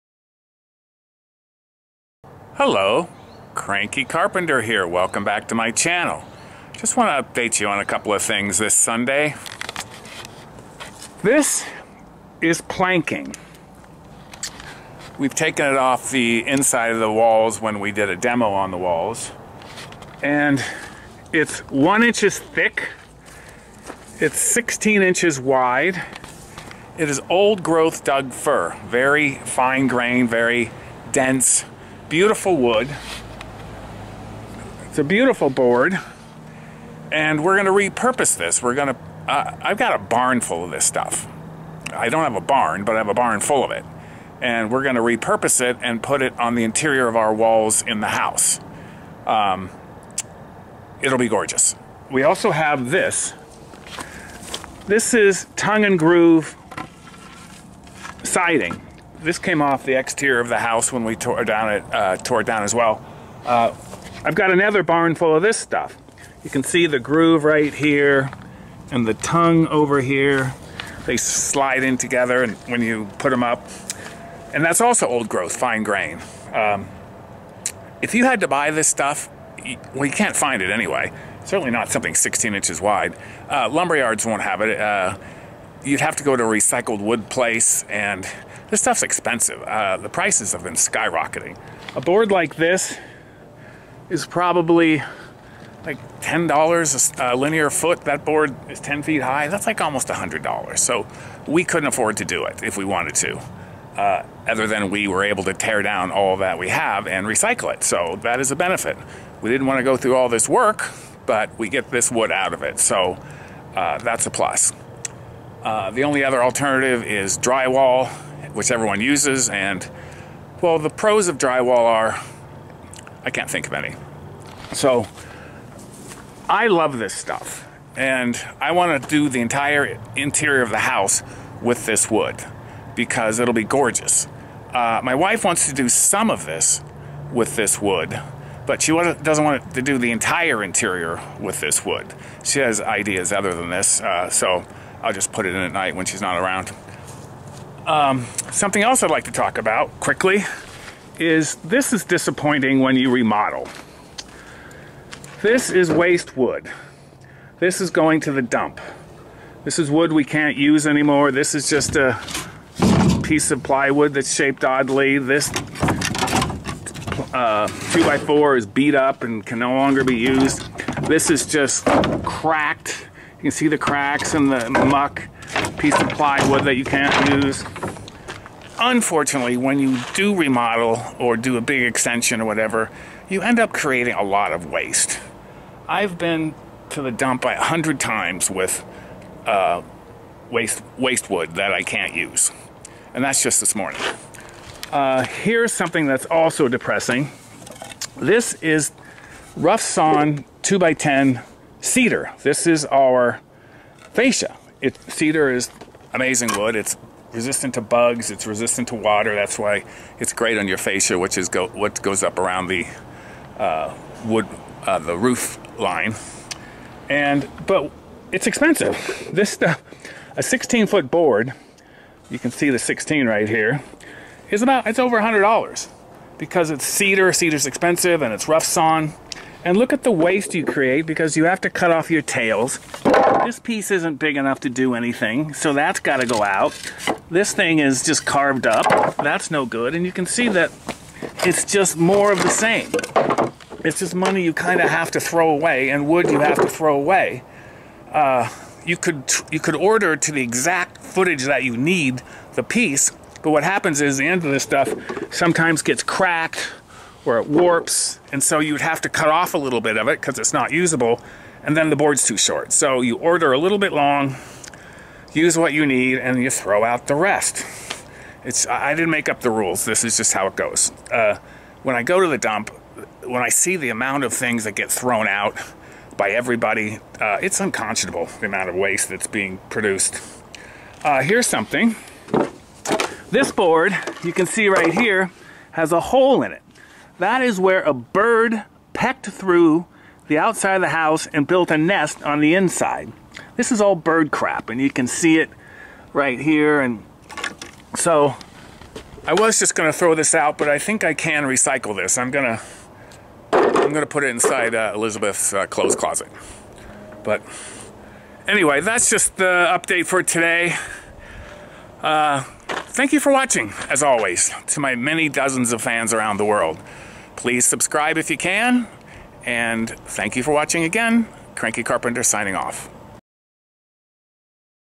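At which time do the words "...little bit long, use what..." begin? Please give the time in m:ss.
4:23.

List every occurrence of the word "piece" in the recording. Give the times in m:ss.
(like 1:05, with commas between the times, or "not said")
2:43, 2:55, 3:53, 4:12.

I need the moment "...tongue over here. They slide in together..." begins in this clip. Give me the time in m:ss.
1:09.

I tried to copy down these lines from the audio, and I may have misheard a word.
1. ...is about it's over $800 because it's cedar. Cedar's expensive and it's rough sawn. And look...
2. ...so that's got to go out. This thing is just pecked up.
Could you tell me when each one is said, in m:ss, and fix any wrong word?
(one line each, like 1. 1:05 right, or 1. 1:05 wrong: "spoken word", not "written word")
1. 3:44 wrong: "100", not "800"
2. 3:55 wrong: "carved", not "pecked".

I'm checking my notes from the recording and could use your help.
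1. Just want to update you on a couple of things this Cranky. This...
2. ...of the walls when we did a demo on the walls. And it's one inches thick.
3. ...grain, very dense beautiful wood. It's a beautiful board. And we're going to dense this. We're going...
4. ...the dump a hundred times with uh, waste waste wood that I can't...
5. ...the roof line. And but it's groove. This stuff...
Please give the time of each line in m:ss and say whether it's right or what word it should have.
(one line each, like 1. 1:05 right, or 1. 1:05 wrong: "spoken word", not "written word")
1. 0:06 wrong: "Sunday", not "Cranky"
2. 0:16 right
3. 0:29 wrong: "repurpose", not "dense"
4. 3:07 right
5. 3:34 wrong: "expensive", not "groove".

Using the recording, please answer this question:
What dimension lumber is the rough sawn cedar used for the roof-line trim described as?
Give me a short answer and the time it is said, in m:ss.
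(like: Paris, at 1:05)
2x10, at 3:20.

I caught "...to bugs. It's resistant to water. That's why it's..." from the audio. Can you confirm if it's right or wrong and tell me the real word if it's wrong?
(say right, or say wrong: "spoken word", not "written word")
right.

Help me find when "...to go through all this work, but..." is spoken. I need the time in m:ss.
1:49.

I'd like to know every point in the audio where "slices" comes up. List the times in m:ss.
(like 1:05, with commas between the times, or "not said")
not said.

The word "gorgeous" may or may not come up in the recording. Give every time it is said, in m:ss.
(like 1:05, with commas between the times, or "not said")
0:51, 2:13.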